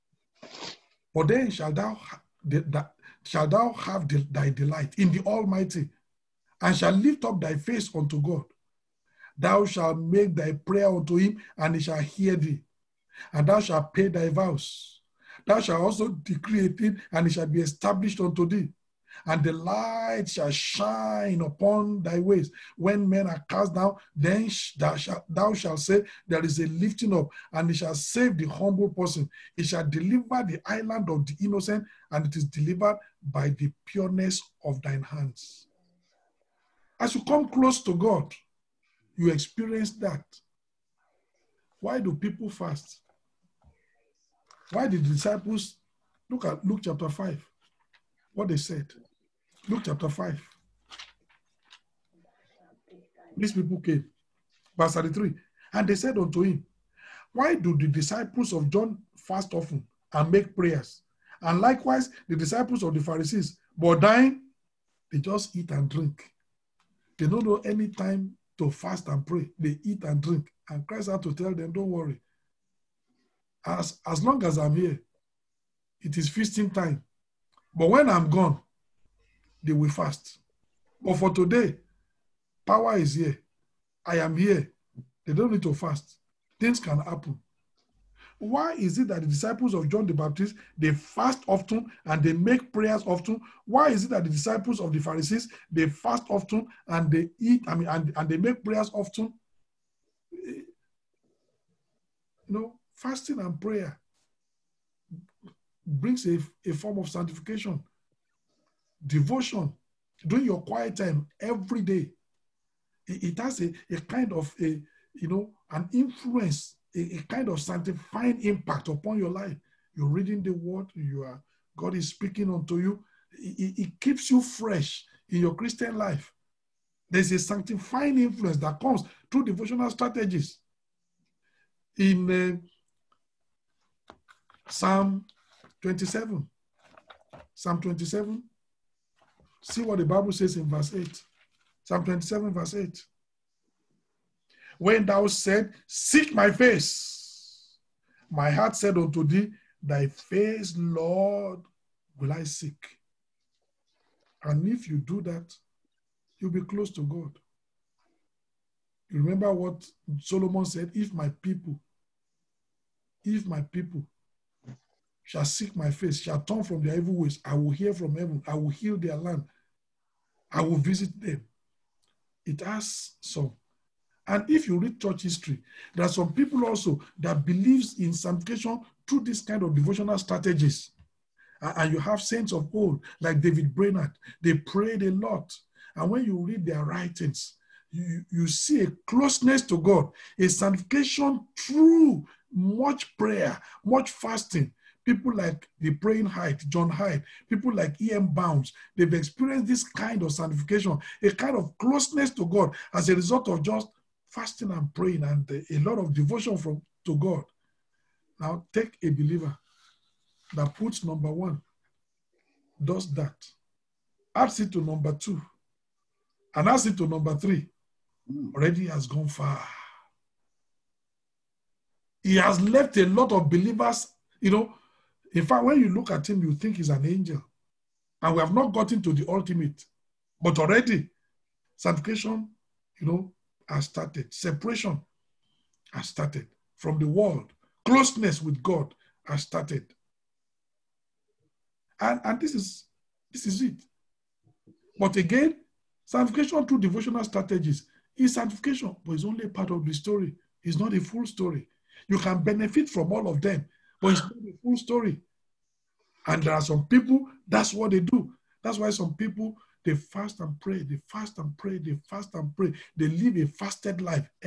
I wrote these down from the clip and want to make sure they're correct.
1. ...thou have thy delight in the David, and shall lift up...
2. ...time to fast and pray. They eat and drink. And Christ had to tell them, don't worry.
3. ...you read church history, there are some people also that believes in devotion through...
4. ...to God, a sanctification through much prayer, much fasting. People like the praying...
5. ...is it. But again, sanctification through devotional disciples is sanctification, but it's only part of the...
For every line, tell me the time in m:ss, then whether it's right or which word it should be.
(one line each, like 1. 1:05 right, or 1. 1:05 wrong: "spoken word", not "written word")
1. 0:03 wrong: "Almighty", not "David"
2. 1:07 right
3. 2:54 wrong: "sanctification", not "devotion"
4. 3:09 right
5. 4:03 wrong: "strategies", not "disciples".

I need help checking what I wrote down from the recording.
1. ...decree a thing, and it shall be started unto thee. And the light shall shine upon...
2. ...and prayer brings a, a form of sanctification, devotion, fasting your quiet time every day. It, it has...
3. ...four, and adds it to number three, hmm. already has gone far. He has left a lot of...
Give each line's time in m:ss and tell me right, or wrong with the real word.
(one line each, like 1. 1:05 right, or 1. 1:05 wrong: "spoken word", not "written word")
1. 0:16 wrong: "established", not "started"
2. 1:43 wrong: "during", not "fasting"
3. 3:35 wrong: "two", not "four".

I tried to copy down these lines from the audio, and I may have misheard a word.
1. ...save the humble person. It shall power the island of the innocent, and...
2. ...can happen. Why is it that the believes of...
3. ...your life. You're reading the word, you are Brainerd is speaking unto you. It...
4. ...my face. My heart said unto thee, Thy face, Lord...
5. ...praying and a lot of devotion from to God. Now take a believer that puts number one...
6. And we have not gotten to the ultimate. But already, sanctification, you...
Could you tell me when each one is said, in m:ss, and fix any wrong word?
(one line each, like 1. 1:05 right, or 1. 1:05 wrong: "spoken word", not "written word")
1. 0:27 wrong: "deliver", not "power"
2. 1:26 wrong: "disciples", not "believes"
3. 1:59 wrong: "God", not "Brainerd"
4. 2:26 right
5. 3:24 right
6. 3:48 right.